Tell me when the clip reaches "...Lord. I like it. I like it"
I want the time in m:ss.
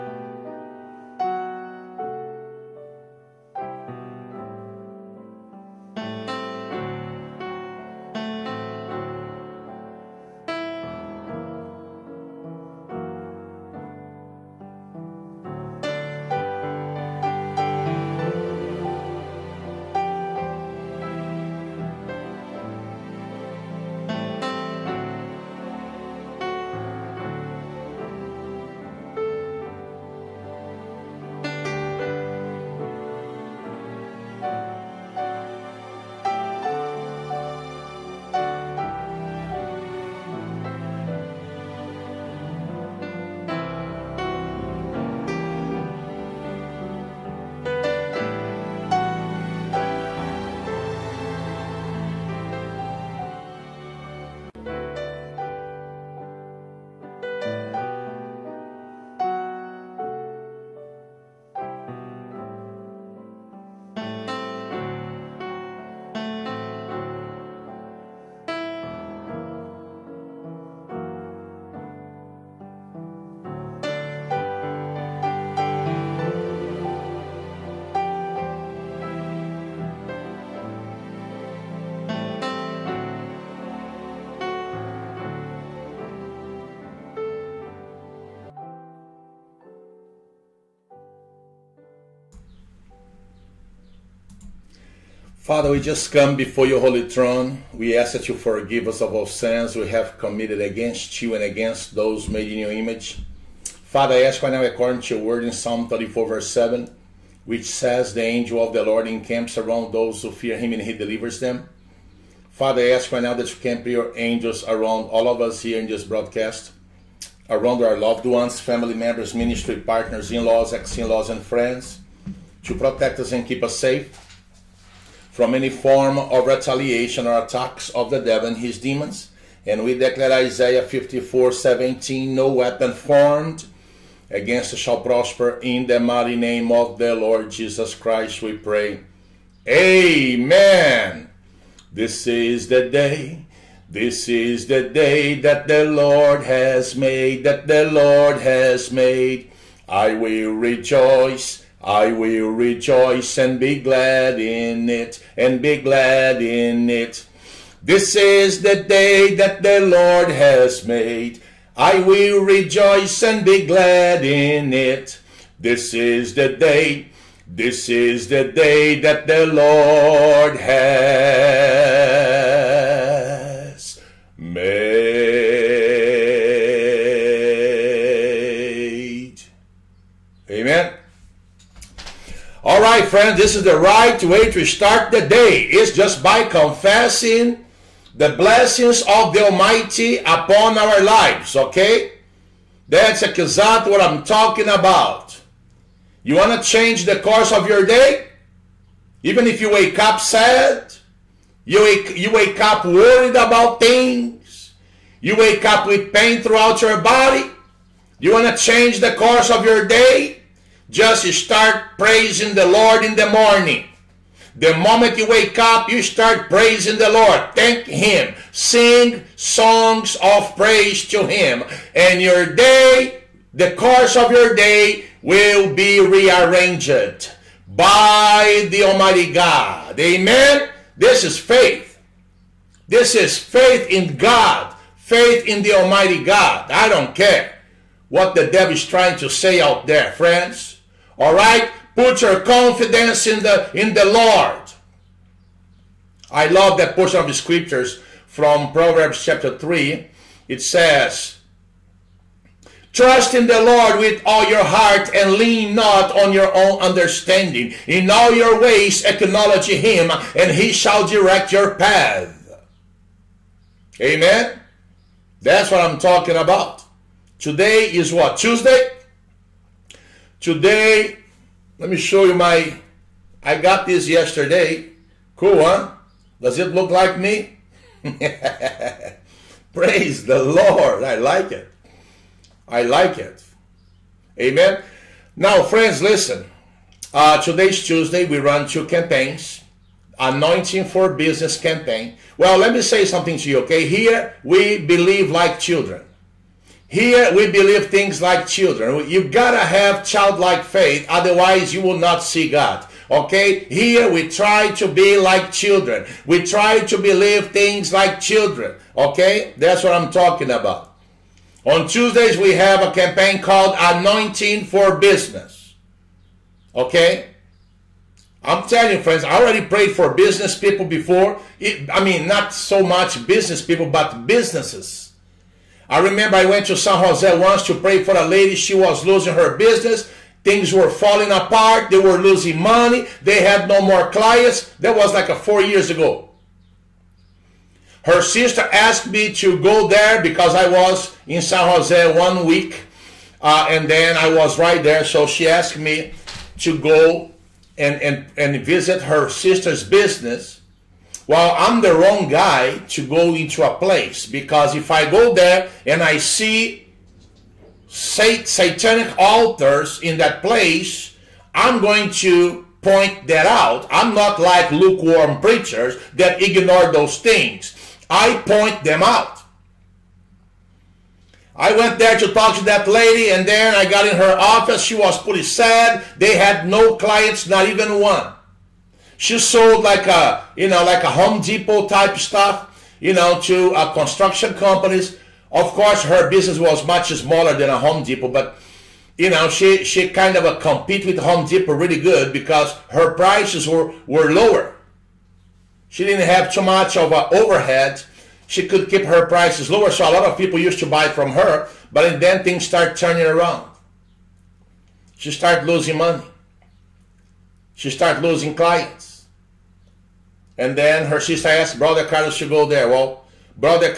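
4:40.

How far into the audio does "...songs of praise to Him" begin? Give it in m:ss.
3:39.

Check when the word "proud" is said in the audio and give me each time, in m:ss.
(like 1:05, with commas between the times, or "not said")
not said.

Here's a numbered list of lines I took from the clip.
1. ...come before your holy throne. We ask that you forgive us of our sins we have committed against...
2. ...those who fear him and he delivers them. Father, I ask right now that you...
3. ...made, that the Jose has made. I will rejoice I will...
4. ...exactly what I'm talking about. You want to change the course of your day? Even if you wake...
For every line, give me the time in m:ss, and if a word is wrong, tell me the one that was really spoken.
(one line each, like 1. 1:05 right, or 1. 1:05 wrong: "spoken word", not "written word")
1. 1:36 right
2. 1:49 right
3. 2:26 wrong: "Lord", not "Jose"
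4. 3:13 right.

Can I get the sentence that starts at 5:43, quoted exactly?
Uh, and then I was right there.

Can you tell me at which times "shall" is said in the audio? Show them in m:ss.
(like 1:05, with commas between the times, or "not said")
2:14, 4:20.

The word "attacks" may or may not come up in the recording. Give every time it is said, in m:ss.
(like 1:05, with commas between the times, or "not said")
2:07.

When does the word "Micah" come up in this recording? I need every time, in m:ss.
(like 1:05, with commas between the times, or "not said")
not said.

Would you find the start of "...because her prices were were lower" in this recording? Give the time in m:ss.
6:32.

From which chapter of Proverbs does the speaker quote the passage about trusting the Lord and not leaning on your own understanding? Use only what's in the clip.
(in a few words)
Proverbs chapter 3.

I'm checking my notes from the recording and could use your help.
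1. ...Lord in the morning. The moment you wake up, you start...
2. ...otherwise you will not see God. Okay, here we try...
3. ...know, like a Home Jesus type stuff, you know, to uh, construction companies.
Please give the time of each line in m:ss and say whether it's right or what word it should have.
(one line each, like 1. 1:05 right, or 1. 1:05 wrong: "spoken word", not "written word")
1. 3:32 right
2. 5:01 right
3. 6:20 wrong: "Depot", not "Jesus".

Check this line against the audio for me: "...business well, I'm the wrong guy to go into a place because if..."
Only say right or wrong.
right.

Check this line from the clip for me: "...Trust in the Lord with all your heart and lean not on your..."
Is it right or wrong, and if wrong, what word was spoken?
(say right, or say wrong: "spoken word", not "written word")
right.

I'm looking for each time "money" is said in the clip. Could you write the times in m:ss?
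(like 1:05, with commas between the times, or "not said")
5:32, 6:45.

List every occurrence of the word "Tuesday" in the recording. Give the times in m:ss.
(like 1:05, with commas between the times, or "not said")
4:28, 4:47, 5:11.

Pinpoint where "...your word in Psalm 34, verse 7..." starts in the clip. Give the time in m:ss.
1:45.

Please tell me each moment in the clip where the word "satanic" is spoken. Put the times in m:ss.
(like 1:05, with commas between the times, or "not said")
5:58.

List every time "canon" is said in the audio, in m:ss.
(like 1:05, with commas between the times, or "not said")
not said.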